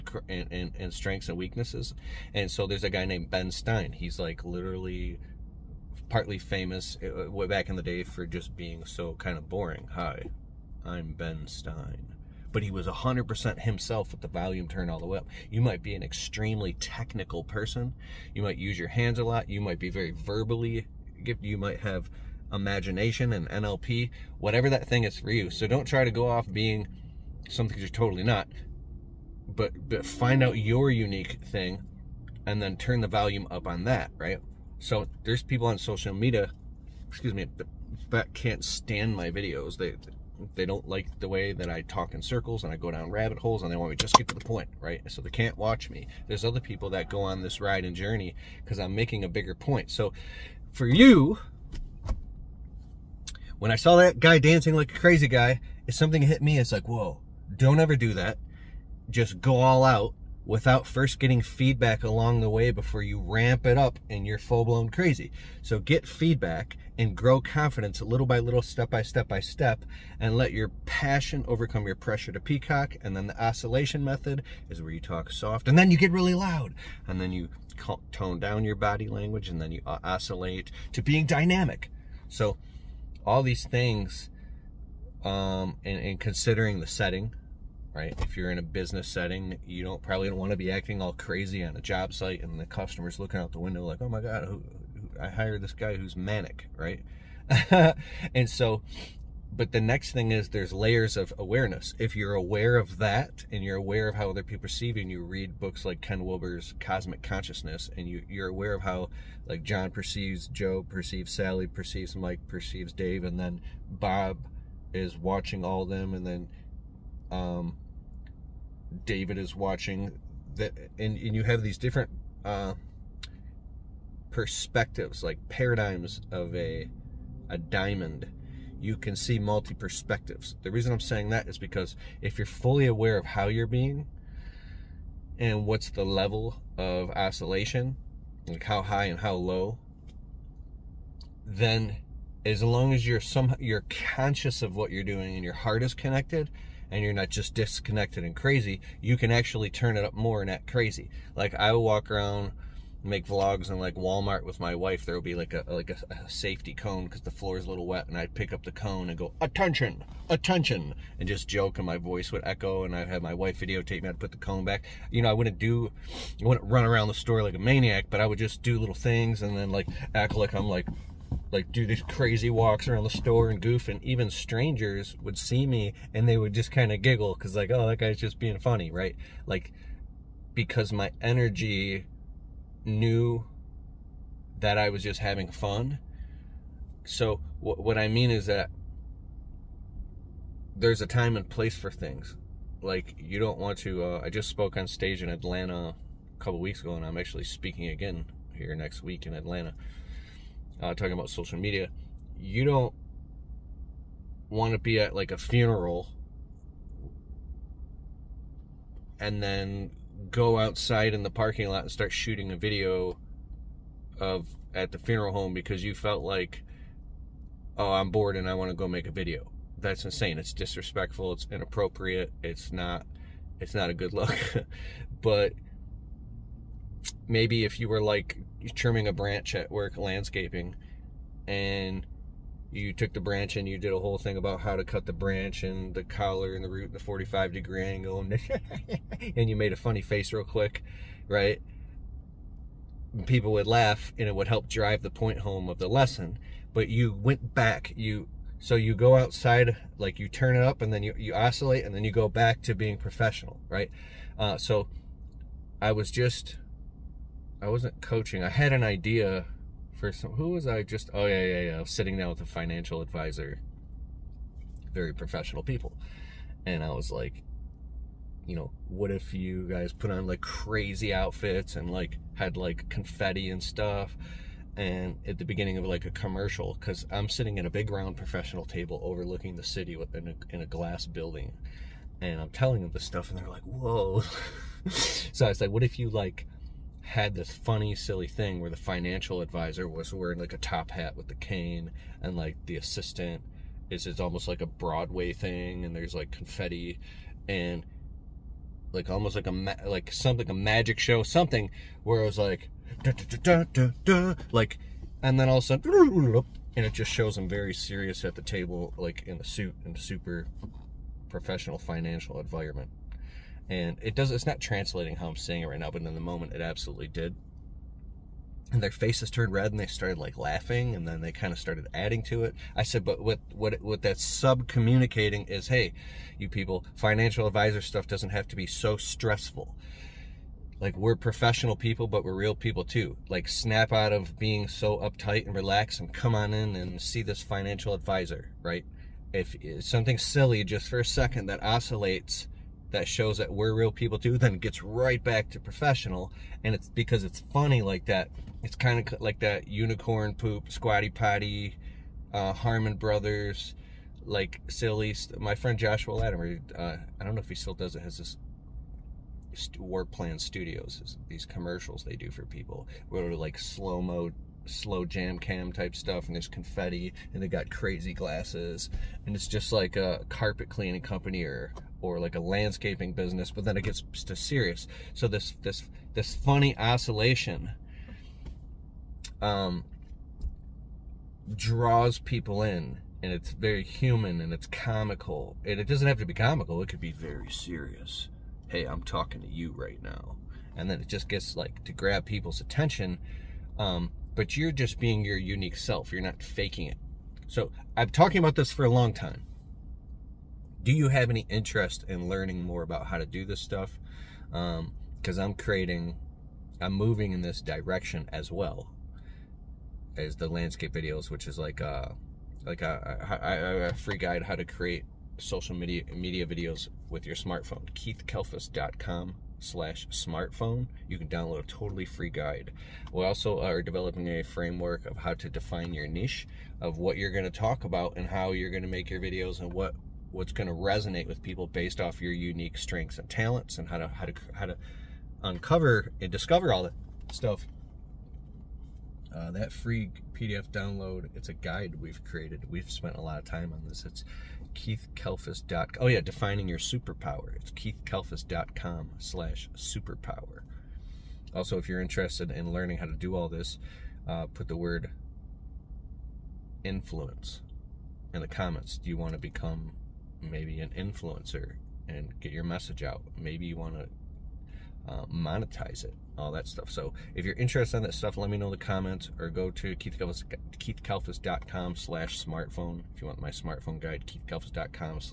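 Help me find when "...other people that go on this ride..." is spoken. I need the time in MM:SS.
00:46.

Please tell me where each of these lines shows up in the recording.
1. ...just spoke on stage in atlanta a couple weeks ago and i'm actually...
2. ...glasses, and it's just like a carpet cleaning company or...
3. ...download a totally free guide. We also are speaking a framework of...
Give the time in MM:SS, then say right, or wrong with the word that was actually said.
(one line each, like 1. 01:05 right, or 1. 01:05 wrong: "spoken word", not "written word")
1. 03:14 right
2. 06:08 right
3. 07:01 wrong: "developing", not "speaking".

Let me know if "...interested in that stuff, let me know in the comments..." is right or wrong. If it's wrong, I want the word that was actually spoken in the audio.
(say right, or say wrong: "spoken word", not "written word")
right.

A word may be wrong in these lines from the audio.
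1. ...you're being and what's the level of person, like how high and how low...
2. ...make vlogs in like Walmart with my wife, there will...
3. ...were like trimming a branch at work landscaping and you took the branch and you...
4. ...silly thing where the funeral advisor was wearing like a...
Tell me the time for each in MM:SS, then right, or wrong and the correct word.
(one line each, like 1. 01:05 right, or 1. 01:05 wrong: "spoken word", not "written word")
1. 02:13 wrong: "oscillation", not "person"
2. 02:33 right
3. 03:47 right
4. 04:47 wrong: "financial", not "funeral".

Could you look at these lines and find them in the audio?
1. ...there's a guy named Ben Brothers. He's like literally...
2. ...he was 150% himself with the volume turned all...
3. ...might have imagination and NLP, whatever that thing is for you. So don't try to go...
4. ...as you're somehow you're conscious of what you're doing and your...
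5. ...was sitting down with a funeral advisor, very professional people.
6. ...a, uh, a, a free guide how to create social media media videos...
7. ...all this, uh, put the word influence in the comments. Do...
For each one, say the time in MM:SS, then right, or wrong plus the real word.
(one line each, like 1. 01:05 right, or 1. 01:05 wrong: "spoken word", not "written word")
1. 00:02 wrong: "Stein", not "Brothers"
2. 00:12 wrong: "100", not "150"
3. 00:21 right
4. 02:22 right
5. 04:21 wrong: "financial", not "funeral"
6. 06:52 right
7. 07:33 right.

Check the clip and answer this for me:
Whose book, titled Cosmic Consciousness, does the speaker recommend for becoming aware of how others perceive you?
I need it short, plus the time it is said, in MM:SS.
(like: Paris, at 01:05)
Ken Wilber, at 01:46.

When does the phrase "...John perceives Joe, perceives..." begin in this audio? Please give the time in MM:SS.
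01:49.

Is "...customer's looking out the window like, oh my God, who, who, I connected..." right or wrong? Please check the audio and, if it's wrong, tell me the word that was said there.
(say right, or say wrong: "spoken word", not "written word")
wrong: "hired", not "connected".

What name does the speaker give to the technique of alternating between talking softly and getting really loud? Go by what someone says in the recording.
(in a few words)
oscillation method.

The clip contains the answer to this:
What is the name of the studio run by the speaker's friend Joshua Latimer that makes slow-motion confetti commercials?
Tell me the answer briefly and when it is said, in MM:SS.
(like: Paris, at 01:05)
Warp Plan Studios, at 05:59.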